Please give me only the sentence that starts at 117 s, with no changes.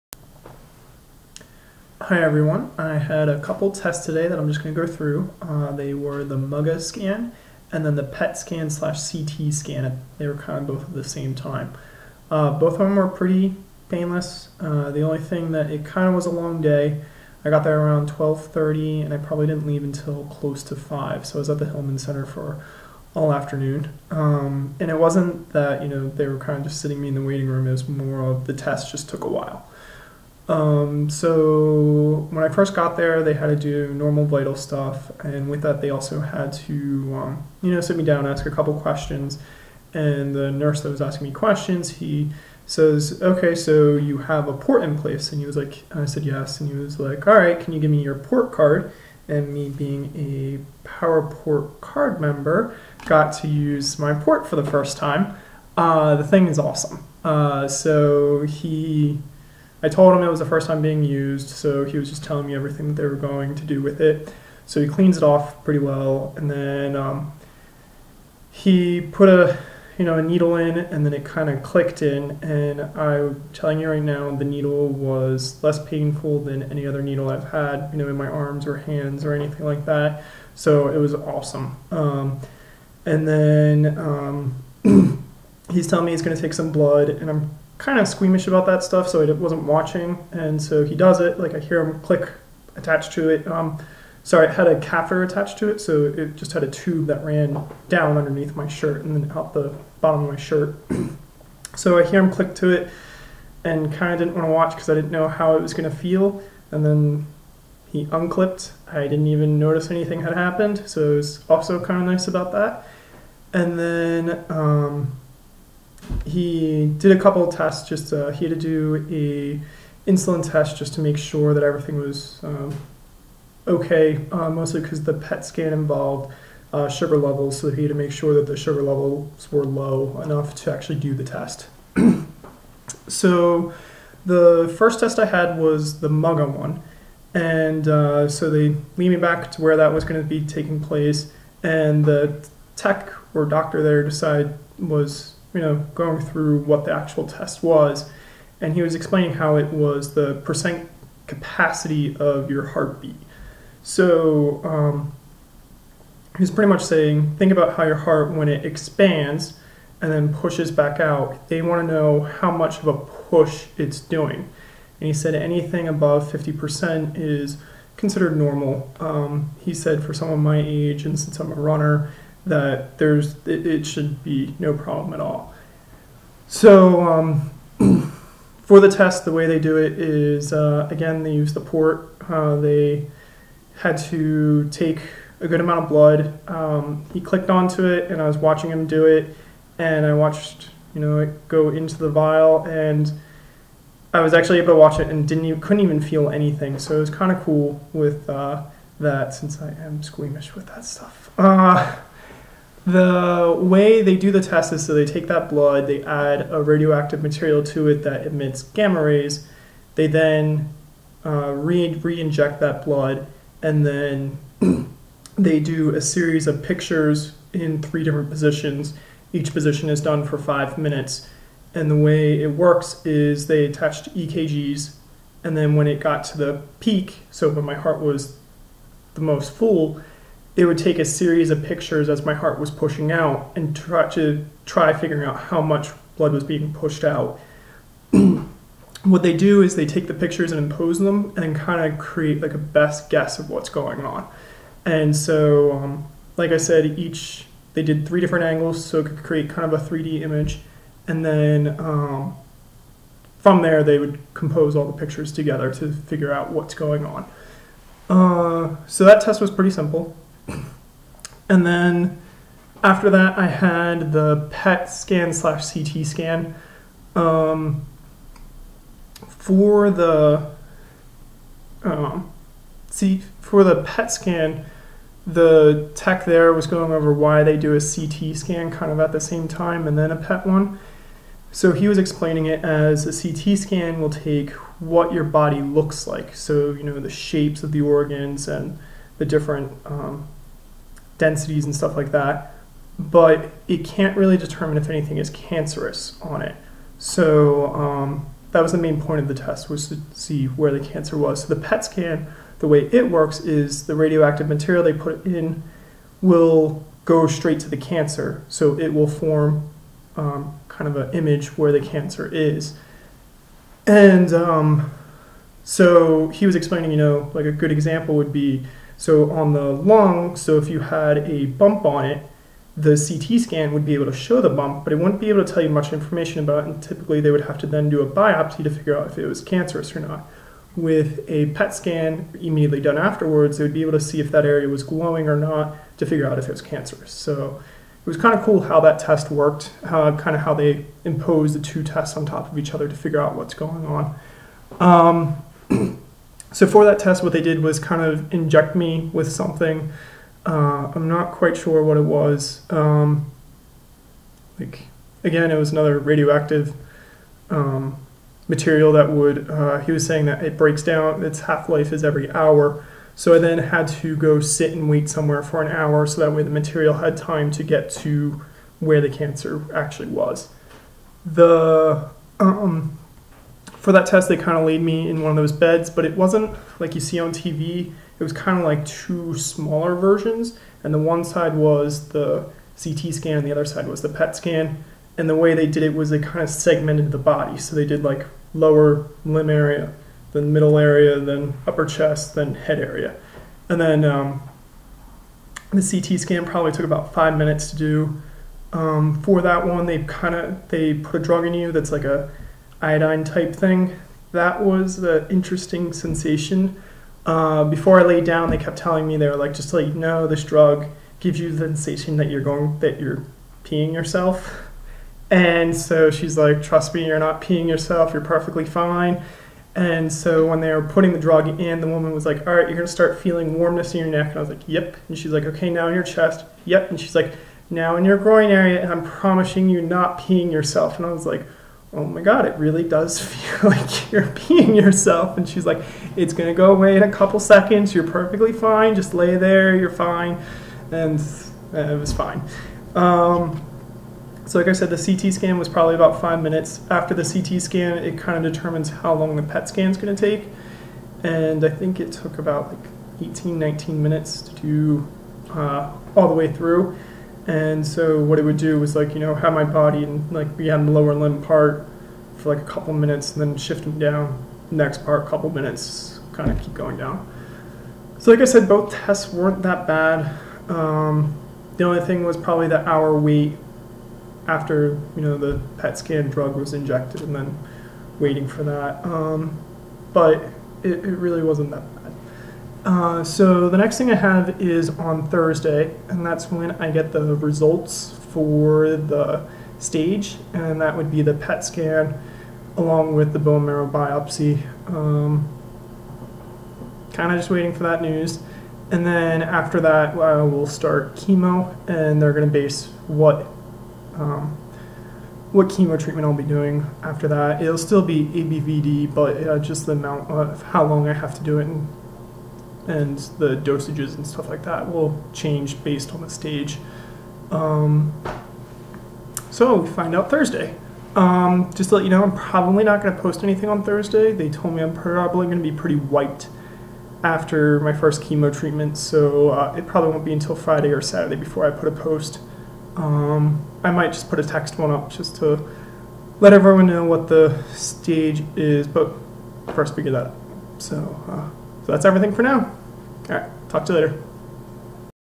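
Just uh, he had to do a insulin test just to make sure that everything was um, okay.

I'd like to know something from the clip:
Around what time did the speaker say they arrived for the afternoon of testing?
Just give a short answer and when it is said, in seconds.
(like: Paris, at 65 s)
12:30, at 18 s.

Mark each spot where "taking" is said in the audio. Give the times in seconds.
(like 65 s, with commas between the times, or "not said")
140 s.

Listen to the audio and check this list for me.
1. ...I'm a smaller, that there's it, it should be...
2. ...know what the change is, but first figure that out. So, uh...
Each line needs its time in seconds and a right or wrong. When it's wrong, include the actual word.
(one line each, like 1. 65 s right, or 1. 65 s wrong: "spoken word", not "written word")
1. 171 s wrong: "runner", not "smaller"
2. 536 s wrong: "stage", not "change".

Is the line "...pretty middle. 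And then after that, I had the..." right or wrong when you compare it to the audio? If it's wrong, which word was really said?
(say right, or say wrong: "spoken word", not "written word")
wrong: "simple", not "middle".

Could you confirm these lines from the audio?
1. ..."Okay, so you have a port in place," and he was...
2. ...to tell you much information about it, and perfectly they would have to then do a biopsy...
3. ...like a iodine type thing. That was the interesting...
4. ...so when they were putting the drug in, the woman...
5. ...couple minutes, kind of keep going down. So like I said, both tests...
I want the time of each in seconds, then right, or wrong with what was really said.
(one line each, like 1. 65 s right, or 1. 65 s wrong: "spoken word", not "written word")
1. 43 s right
2. 325 s wrong: "typically", not "perfectly"
3. 401 s right
4. 420 s right
5. 465 s right.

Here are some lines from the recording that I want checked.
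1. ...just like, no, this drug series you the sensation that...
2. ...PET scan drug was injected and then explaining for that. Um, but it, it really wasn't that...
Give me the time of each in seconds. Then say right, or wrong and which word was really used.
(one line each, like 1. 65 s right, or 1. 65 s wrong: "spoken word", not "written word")
1. 409 s wrong: "gives", not "series"
2. 475 s wrong: "waiting", not "explaining".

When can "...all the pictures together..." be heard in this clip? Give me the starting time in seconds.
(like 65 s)
254 s.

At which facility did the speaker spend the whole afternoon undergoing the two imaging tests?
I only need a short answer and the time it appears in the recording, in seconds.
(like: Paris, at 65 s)
Hillman Center, at 21 s.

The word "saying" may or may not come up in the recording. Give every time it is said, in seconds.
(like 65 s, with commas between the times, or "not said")
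156 s, 360 s.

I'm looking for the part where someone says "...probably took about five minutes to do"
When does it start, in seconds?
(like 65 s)
396 s.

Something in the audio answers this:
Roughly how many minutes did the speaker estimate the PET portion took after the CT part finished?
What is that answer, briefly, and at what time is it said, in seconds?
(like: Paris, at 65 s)
18-19 minutes, at 453 s.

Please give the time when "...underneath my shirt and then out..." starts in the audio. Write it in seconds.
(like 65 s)
98 s.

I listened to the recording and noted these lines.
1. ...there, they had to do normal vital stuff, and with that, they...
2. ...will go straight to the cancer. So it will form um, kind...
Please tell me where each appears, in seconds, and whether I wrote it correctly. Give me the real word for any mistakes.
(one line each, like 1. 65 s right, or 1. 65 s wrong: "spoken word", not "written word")
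1. 32 s right
2. 306 s right.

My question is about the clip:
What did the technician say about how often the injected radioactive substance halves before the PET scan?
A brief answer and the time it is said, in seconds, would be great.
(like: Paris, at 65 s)
Every hour, at 362 s.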